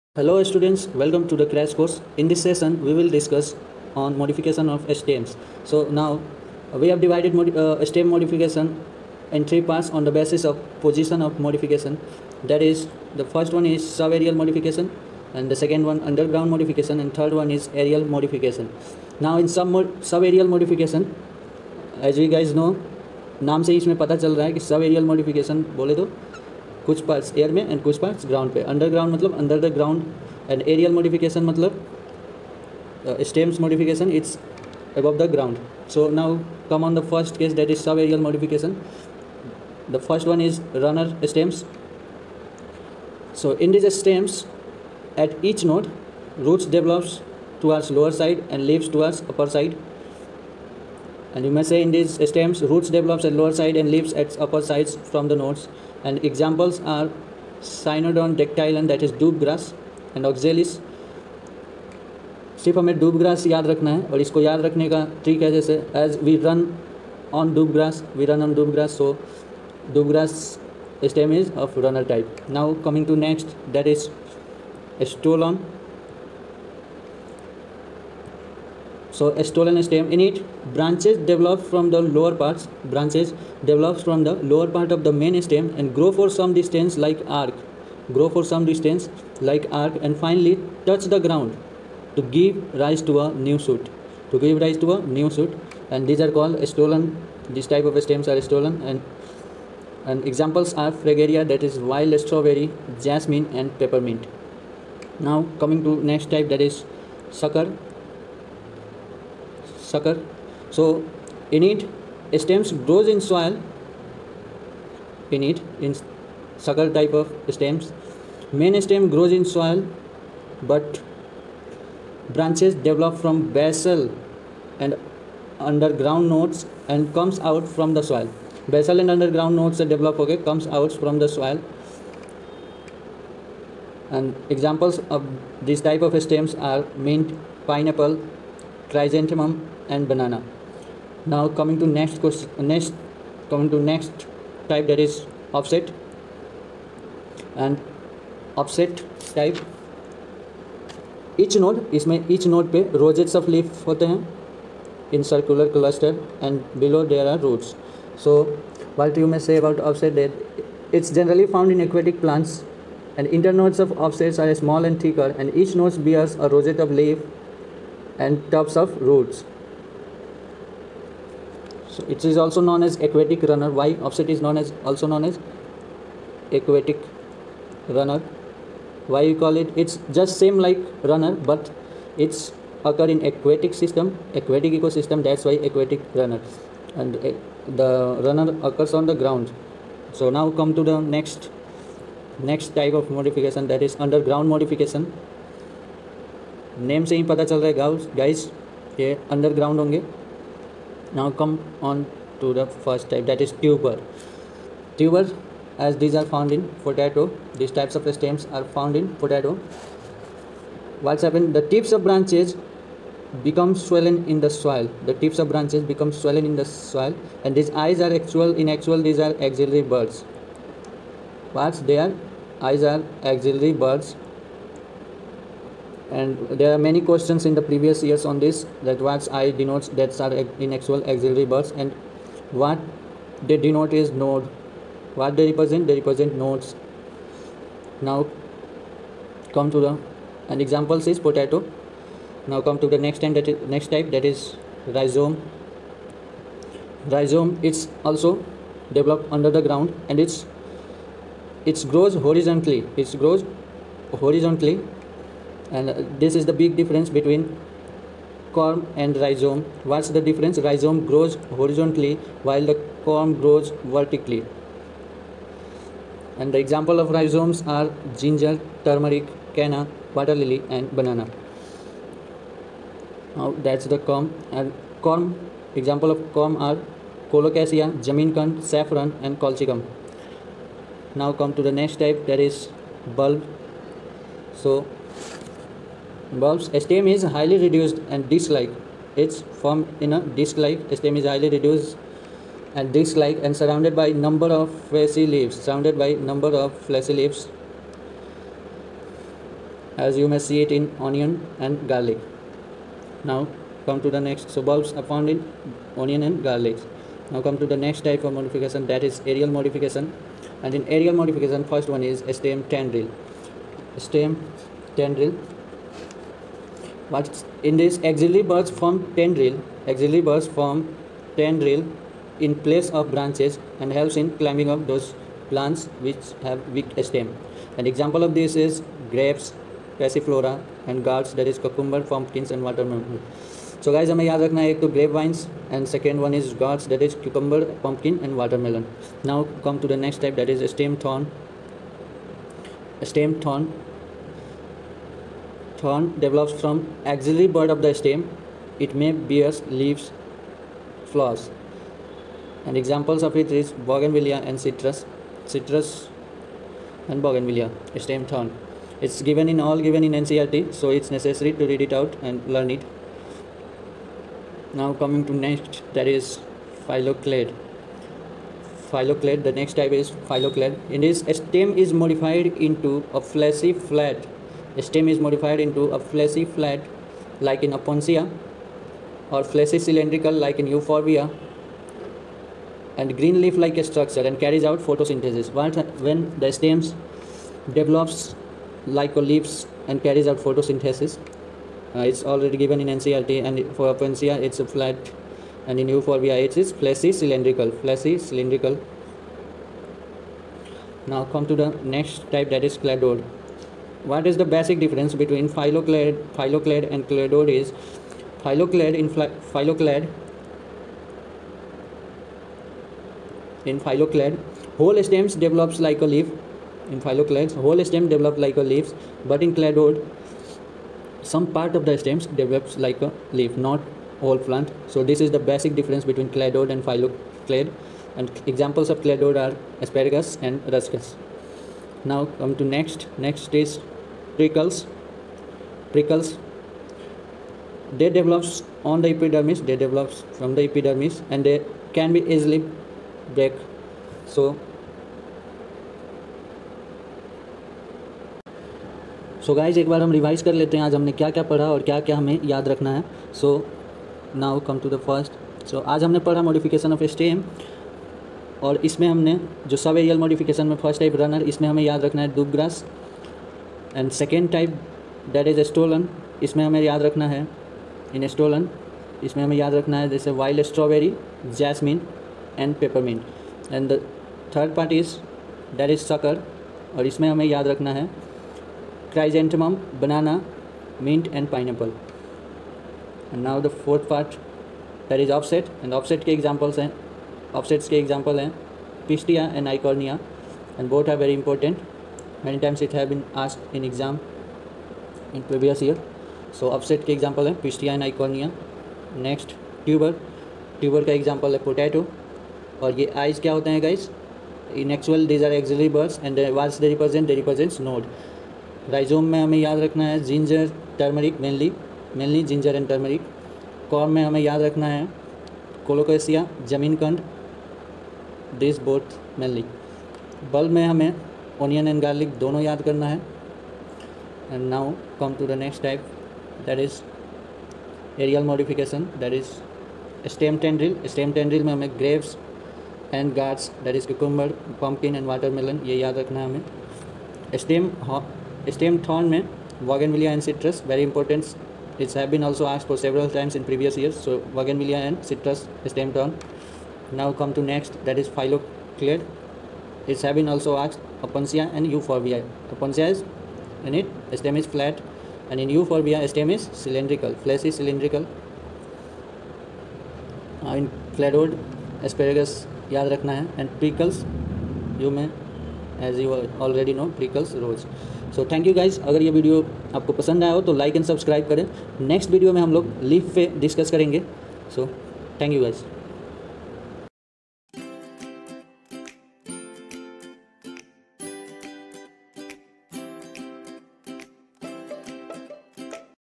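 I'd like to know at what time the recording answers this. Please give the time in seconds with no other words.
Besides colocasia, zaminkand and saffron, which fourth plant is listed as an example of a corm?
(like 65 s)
279 s.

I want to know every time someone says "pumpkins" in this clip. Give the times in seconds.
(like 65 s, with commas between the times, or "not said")
332 s, 337 s.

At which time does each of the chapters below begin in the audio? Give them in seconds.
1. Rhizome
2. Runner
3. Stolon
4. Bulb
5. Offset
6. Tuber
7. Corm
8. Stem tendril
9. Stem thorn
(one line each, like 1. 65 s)
1. 245 s
2. 40 s
3. 75 s
4. 285 s
5. 148 s
6. 205 s
7. 260 s
8. 313 s
9. 345 s.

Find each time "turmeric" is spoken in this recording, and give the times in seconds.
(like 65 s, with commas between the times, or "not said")
268 s.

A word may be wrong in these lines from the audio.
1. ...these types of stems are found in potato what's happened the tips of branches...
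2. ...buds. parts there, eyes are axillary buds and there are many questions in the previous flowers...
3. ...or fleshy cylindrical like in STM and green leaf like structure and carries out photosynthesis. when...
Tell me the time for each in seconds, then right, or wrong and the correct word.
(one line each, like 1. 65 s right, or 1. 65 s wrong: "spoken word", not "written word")
1. 207 s right
2. 219 s wrong: "years", not "flowers"
3. 379 s wrong: "Euphorbia", not "STM".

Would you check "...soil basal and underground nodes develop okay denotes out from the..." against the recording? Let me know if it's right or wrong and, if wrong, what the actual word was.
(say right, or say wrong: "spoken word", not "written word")
wrong: "comes", not "denotes".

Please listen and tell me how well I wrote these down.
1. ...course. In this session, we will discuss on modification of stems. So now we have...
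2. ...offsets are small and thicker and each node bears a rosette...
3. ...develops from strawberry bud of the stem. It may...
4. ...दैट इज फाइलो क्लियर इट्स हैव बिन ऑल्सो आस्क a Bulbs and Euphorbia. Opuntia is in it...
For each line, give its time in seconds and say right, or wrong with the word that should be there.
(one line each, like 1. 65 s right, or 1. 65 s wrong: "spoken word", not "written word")
1. 1 s right
2. 164 s right
3. 346 s wrong: "axillary", not "strawberry"
4. 548 s wrong: "Opuntia", not "Bulbs".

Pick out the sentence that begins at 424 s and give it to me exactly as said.
So this is the basic difference between cladode and phylloclad.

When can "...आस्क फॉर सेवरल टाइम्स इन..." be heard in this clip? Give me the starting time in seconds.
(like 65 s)
542 s.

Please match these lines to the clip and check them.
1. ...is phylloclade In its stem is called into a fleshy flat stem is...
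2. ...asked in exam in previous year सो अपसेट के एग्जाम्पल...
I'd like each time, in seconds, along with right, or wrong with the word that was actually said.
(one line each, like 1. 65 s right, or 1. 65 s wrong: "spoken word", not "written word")
1. 369 s wrong: "modified", not "called"
2. 493 s right.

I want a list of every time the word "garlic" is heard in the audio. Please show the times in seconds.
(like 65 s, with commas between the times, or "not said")
301 s, 306 s.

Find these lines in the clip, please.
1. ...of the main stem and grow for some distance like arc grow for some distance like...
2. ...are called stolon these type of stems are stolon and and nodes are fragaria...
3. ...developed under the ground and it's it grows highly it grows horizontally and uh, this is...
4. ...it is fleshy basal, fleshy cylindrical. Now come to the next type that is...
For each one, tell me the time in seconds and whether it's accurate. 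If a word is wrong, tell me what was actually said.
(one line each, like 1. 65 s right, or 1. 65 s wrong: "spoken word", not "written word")
1. 84 s right
2. 96 s wrong: "examples", not "nodes"
3. 248 s wrong: "horizontally", not "highly"
4. 396 s wrong: "cylindrical", not "basal".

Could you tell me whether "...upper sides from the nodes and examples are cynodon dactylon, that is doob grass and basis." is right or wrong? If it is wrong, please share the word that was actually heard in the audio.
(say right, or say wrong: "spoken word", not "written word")
wrong: "oxalis", not "basis".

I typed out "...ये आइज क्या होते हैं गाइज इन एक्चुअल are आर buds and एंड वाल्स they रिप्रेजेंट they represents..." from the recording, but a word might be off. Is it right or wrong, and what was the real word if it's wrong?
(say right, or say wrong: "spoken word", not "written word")
right.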